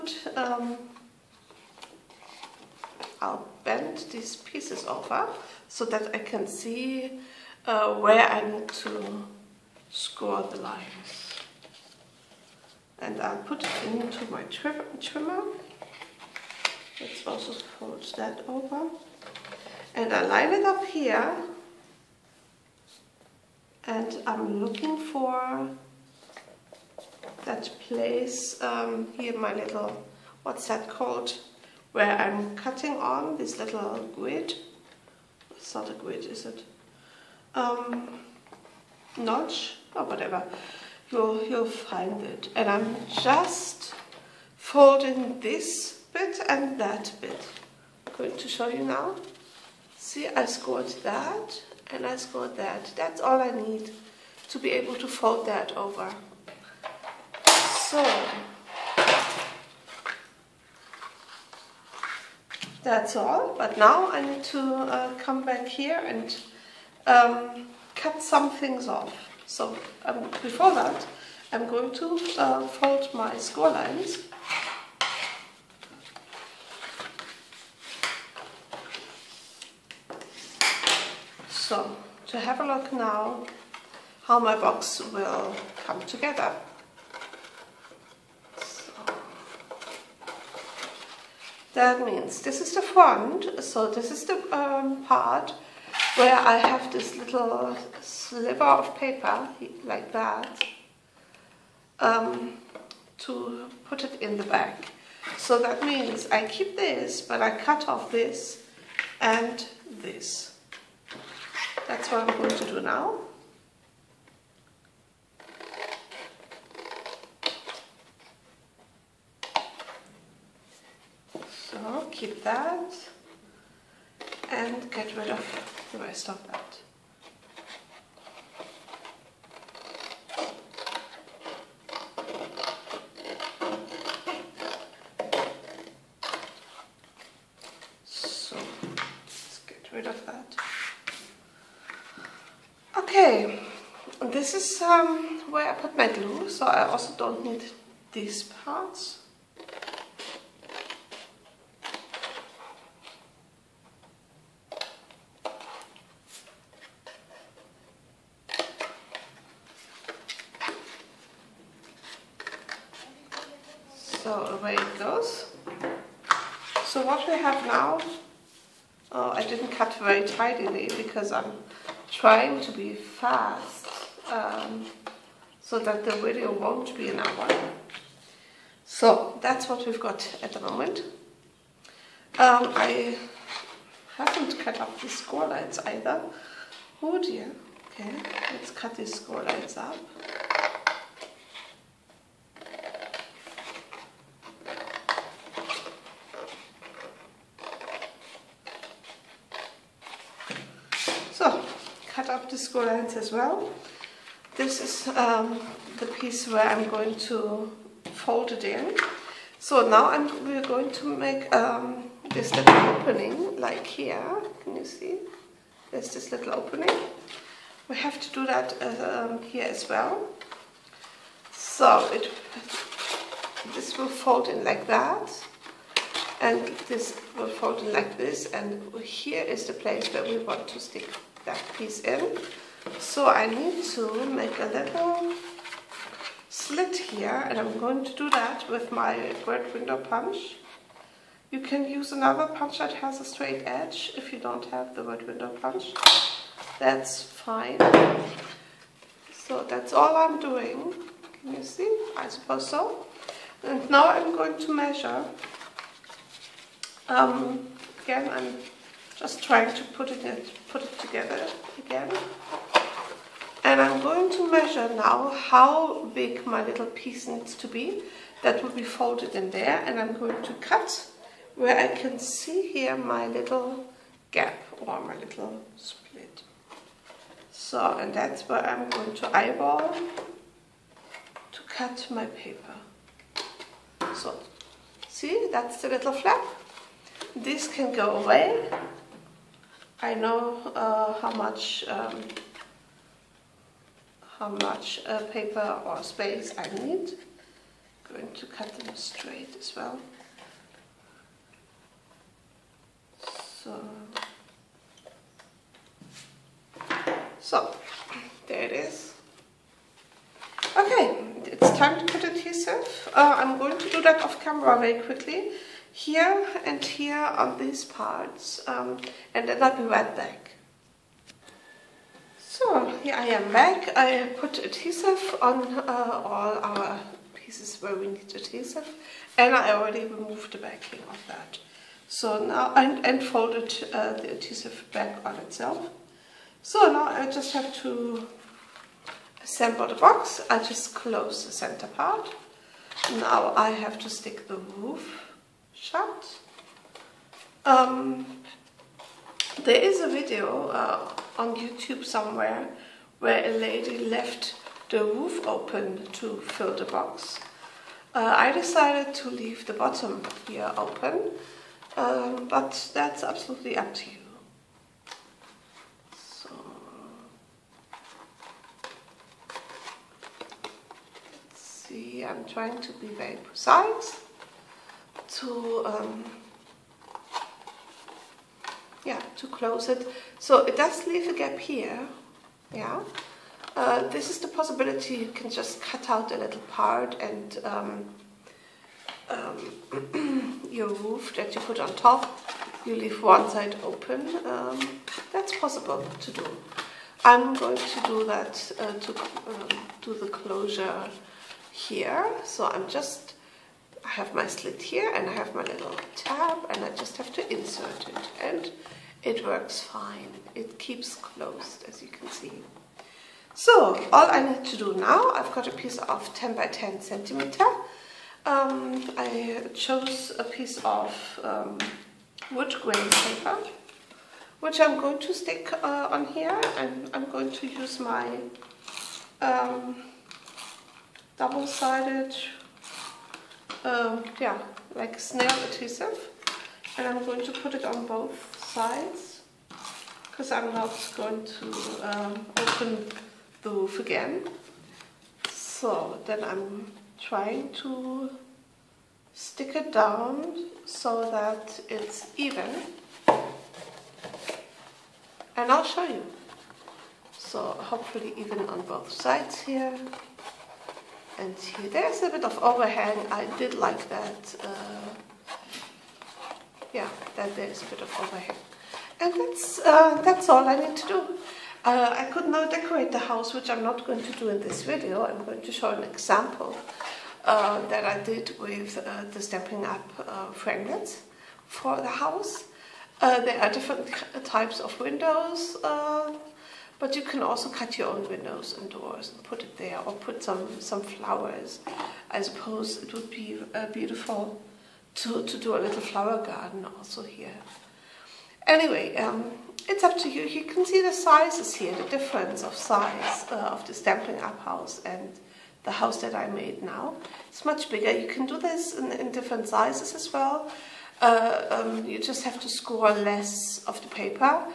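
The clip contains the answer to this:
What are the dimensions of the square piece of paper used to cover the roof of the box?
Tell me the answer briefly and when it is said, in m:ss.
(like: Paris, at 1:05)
10 by 10 centimeters, at 6:56.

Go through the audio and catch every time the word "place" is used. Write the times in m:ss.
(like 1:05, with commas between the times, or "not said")
0:27, 3:49.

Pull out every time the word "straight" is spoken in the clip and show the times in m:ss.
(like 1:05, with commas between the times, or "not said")
4:03, 4:58.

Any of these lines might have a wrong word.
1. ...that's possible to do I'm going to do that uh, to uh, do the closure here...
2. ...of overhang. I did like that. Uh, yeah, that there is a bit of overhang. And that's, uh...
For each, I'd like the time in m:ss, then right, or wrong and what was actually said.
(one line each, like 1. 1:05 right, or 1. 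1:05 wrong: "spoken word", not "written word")
1. 6:35 right
2. 7:42 right.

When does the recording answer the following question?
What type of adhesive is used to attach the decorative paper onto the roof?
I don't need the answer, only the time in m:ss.
7:15.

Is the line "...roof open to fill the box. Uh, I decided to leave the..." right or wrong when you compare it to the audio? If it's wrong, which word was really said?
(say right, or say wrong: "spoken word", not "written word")
right.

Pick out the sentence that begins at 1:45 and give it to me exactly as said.
So that means I keep this, but I cut off this and this.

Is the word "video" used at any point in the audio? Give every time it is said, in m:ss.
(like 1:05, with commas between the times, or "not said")
2:56, 5:50, 7:54.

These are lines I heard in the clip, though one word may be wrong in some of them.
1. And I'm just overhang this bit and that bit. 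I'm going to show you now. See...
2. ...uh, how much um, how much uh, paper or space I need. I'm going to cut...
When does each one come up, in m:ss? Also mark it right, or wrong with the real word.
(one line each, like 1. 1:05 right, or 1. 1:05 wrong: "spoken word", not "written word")
1. 0:42 wrong: "folding", not "overhang"
2. 4:50 right.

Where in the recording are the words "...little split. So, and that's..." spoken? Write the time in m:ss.
4:35.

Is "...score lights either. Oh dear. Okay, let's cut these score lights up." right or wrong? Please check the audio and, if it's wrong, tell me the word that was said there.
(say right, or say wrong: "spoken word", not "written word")
right.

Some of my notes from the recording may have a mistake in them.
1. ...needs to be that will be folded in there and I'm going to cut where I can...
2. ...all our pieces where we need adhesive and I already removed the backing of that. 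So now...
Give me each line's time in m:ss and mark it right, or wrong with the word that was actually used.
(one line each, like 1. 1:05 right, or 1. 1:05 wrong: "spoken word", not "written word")
1. 4:27 right
2. 5:26 right.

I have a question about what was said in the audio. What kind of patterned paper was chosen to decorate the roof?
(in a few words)
wood grain paper.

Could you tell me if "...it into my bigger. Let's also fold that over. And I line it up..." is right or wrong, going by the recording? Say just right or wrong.
wrong.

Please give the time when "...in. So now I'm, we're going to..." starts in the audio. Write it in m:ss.
3:28.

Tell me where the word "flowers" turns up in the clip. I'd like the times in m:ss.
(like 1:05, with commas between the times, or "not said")
8:11, 8:15.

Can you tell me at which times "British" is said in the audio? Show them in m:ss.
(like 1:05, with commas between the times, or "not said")
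not said.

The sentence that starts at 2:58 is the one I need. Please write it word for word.
So that's what we've got at the moment.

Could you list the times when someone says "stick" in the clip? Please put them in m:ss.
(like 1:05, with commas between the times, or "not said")
3:50, 5:44, 7:05, 7:29.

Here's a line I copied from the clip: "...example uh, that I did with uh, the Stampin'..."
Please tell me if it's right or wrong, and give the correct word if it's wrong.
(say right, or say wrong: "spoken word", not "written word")
right.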